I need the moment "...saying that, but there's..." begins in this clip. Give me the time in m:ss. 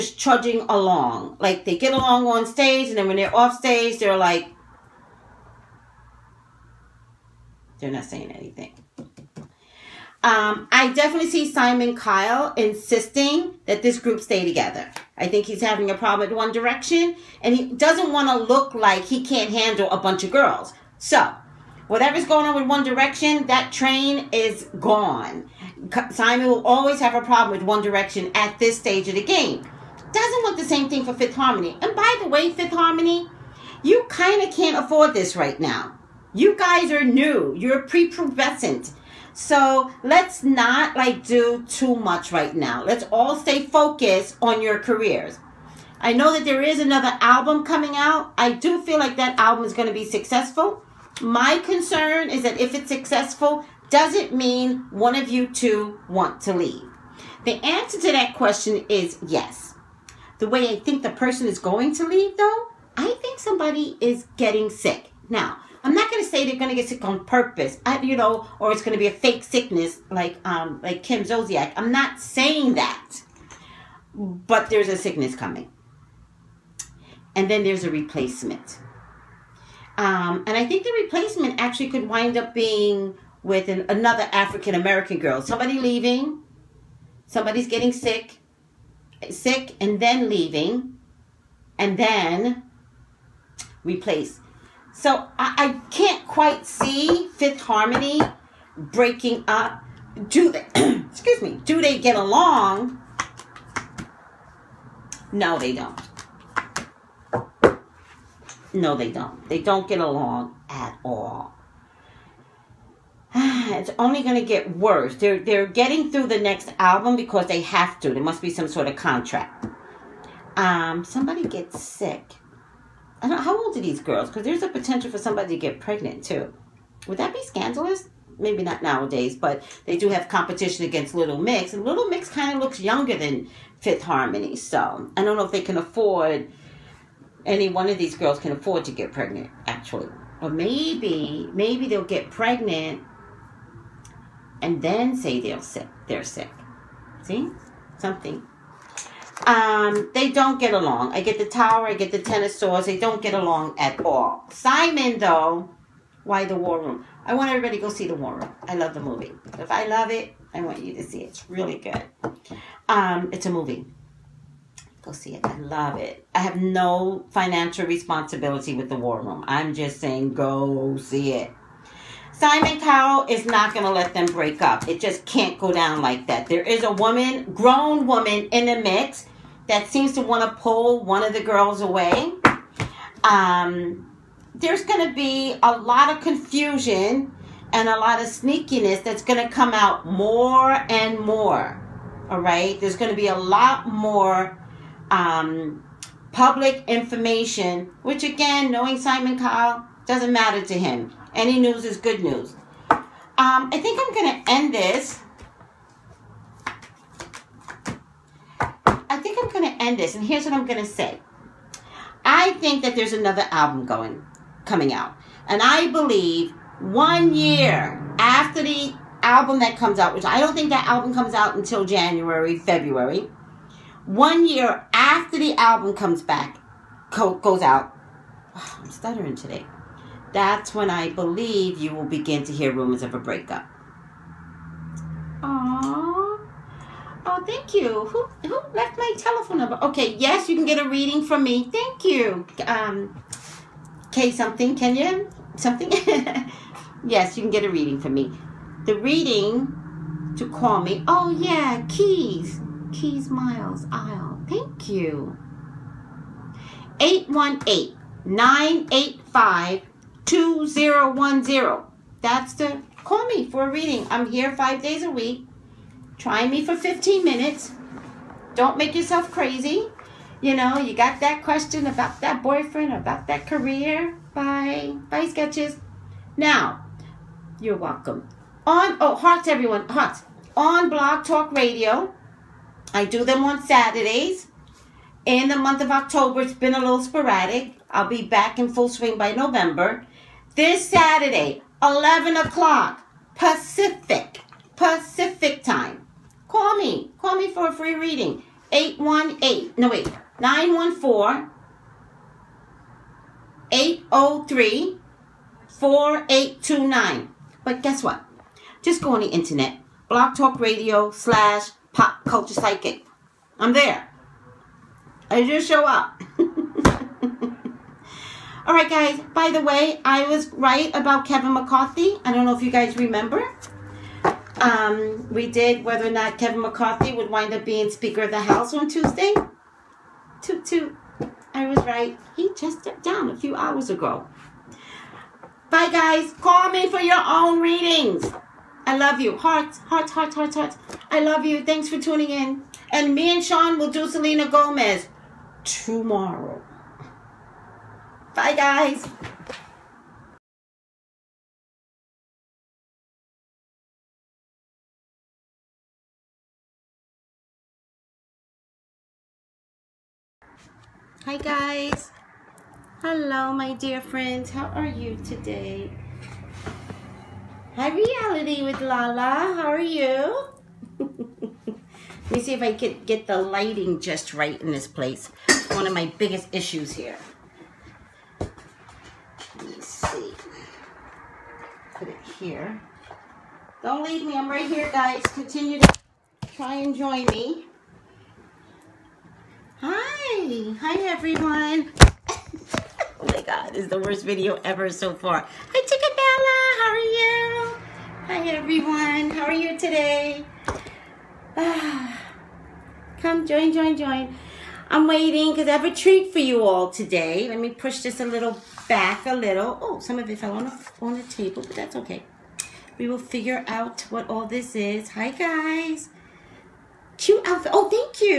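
1:12.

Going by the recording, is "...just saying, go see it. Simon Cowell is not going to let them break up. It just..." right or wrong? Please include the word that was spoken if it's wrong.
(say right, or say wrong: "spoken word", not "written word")
right.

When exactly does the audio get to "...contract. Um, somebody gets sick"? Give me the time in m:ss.
1:58.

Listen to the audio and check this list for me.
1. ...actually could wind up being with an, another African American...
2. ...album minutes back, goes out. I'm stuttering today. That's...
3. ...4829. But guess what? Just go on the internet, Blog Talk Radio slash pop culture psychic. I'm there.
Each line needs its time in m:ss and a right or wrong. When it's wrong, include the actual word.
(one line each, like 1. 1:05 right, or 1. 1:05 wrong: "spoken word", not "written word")
1. 1:21 right
2. 3:45 wrong: "comes", not "minutes"
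3. 5:05 right.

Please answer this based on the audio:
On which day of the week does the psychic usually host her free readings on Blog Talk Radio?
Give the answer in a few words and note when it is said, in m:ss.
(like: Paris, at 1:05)
Saturdays, at 4:43.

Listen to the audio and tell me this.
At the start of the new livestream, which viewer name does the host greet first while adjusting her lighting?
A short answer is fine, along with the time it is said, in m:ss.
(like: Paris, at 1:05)
Reality with Lala, at 6:07.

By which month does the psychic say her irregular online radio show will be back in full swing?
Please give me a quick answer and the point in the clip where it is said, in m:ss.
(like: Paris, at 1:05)
November, at 4:49.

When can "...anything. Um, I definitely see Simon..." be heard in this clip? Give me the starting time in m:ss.
0:08.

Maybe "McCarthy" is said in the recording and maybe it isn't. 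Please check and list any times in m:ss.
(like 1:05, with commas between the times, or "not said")
5:21, 5:26.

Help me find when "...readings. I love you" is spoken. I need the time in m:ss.
5:37.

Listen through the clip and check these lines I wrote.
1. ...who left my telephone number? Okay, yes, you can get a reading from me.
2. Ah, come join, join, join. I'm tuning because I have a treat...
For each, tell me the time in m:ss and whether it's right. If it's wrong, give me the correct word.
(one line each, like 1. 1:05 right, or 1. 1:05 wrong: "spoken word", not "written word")
1. 3:58 right
2. 6:41 wrong: "waiting", not "tuning".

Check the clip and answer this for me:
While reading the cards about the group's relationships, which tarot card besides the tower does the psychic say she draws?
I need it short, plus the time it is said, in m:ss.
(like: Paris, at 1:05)
Ten of Swords, at 2:32.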